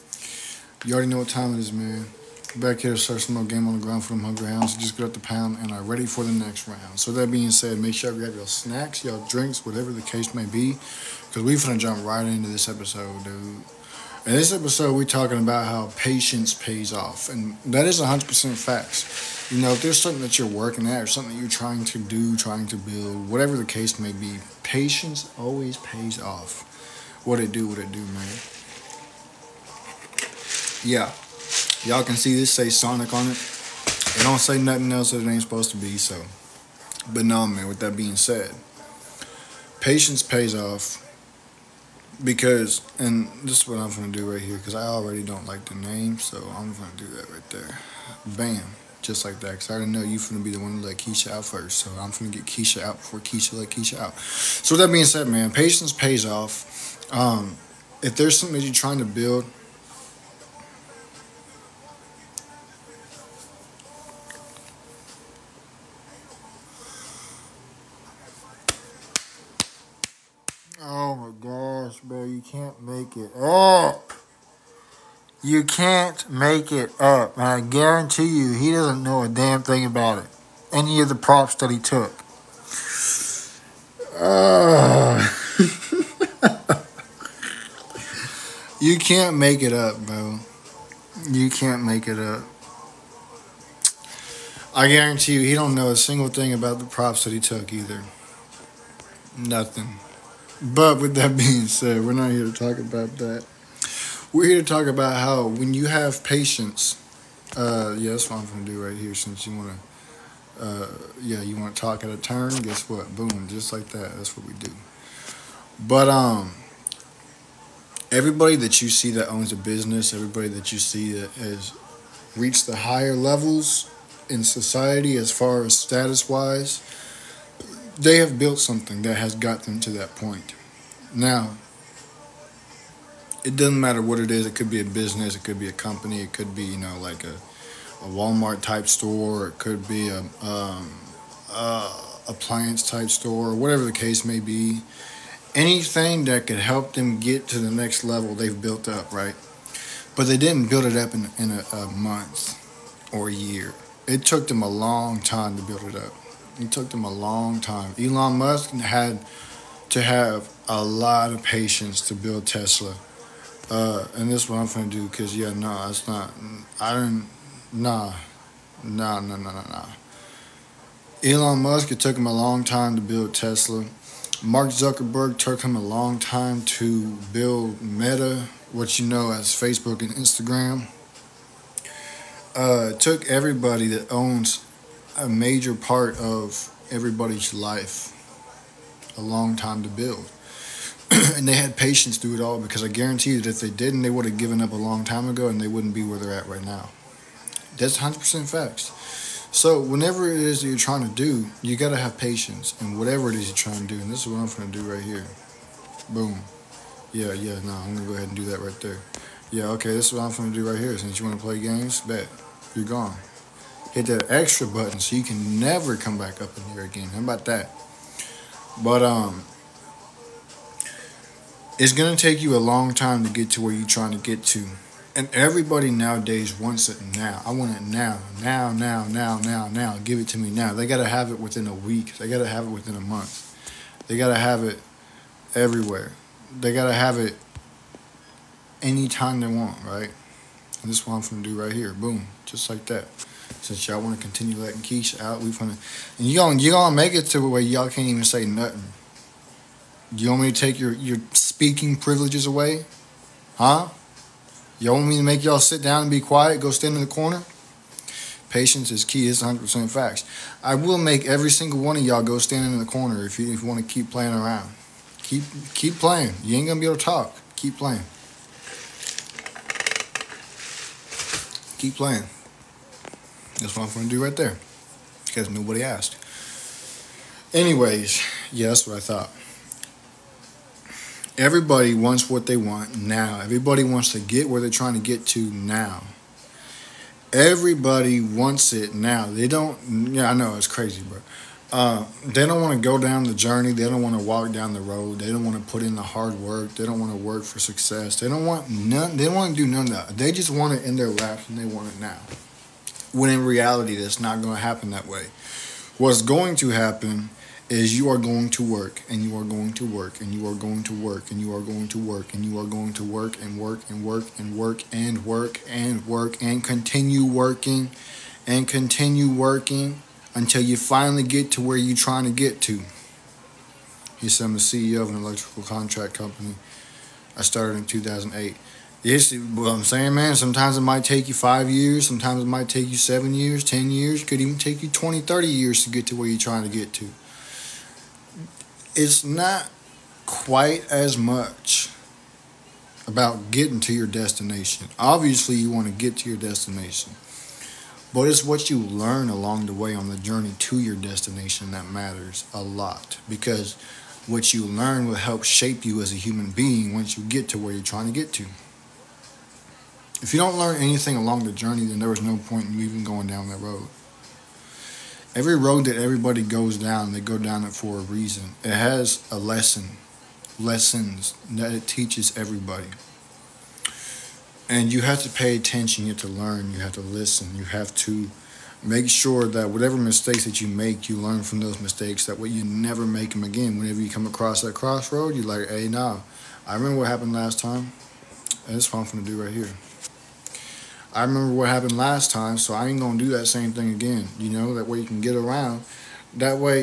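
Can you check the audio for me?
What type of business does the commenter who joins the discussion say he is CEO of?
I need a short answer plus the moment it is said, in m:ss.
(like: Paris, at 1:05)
electrical contract company, at 5:25.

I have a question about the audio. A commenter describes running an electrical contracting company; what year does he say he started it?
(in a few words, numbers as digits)
2008.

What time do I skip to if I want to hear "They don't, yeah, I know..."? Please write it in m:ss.
4:49.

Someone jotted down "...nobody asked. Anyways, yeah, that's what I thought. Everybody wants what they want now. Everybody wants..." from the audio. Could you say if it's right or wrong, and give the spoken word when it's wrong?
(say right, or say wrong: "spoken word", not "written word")
right.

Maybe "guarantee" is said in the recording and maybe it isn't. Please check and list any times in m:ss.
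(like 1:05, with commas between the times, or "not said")
1:17, 1:34, 3:12.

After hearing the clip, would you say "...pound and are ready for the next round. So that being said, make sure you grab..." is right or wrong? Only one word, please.
right.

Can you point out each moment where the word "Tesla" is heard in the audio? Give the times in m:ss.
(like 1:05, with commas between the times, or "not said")
2:42, 2:53.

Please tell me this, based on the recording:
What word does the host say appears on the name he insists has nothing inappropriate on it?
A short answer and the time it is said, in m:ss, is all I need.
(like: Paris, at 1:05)
Sonic, at 0:32.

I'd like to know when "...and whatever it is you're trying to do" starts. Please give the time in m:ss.
3:22.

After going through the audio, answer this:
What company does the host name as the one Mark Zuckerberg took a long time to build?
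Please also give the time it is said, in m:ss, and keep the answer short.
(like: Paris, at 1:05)
Meta, at 2:57.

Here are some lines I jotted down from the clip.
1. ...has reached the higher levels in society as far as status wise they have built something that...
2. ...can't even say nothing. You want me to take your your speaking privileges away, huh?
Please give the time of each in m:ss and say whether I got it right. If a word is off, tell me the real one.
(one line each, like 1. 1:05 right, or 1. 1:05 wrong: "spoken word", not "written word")
1. 2:01 right
2. 4:07 right.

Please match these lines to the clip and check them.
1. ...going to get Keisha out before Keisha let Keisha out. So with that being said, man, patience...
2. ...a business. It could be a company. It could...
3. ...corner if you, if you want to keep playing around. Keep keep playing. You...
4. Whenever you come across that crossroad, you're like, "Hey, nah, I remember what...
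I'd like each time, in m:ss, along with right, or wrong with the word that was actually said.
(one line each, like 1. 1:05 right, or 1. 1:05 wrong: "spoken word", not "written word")
1. 0:52 right
2. 2:14 right
3. 4:22 right
4. 6:23 right.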